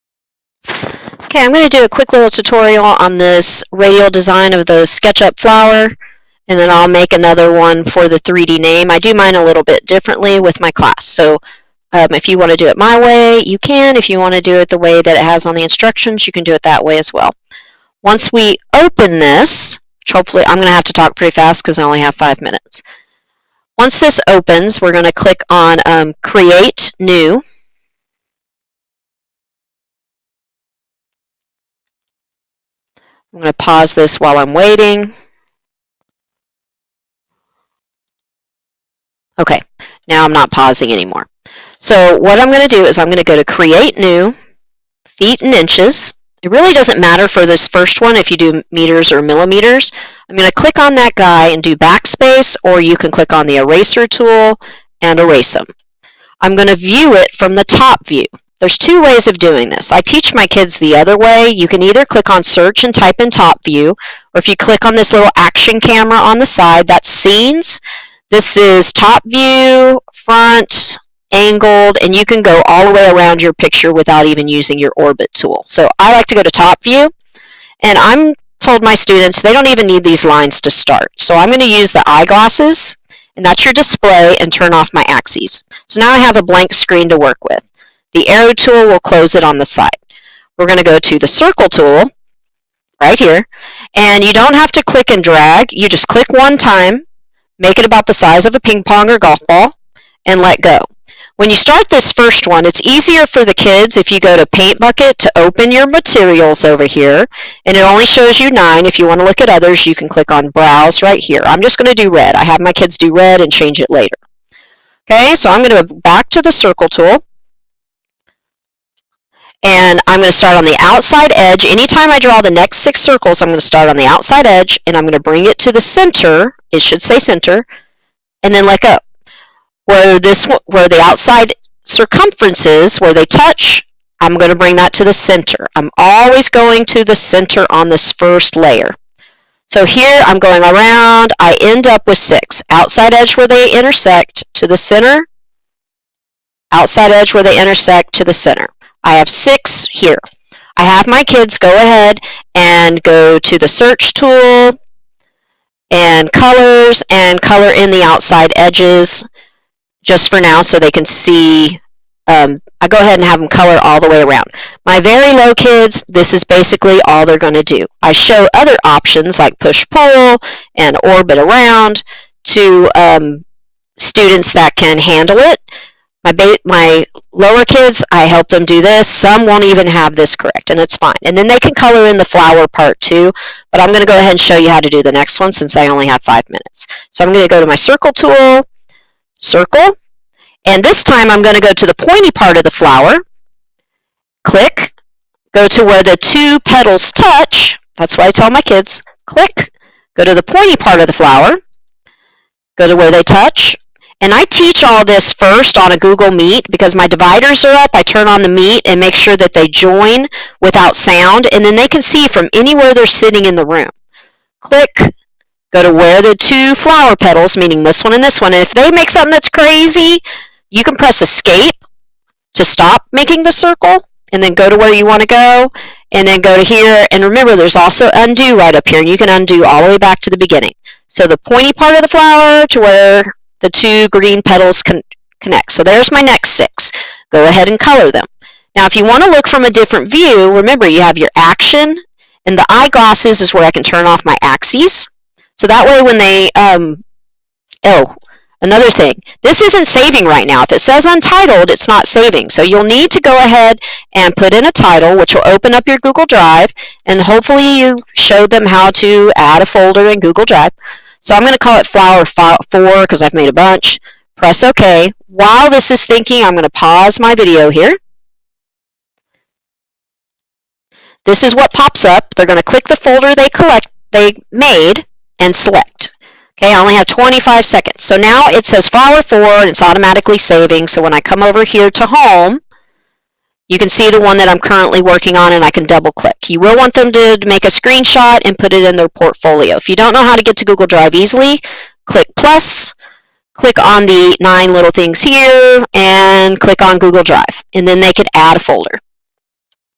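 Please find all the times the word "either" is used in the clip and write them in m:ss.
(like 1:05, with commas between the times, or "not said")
1:01.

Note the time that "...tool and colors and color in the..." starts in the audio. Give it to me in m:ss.
2:34.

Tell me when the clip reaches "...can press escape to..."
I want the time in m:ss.
3:40.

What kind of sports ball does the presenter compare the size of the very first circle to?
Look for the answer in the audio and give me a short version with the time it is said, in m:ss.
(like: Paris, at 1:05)
ping pong or golf ball, at 1:38.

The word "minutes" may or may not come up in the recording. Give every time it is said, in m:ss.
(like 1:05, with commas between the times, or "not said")
0:22, 3:06.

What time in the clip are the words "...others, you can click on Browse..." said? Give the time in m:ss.
1:49.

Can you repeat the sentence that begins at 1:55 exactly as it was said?
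Okay, so I'm going to go back to the circle tool and I'm going to start on the outside edge.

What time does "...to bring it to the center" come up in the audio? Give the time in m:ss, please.
2:05.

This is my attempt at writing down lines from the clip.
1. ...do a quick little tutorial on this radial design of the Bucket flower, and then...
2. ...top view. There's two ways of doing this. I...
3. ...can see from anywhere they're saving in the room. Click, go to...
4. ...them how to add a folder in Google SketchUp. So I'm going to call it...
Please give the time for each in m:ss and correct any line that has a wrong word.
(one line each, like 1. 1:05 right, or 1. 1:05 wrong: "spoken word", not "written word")
1. 0:01 wrong: "SketchUp", not "Bucket"
2. 0:57 right
3. 3:31 wrong: "sitting", not "saving"
4. 4:18 wrong: "Drive", not "SketchUp".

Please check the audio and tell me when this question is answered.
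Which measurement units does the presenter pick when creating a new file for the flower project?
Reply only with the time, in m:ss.
0:45.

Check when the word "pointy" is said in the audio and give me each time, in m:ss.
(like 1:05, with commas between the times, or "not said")
3:11, 3:20, 3:51.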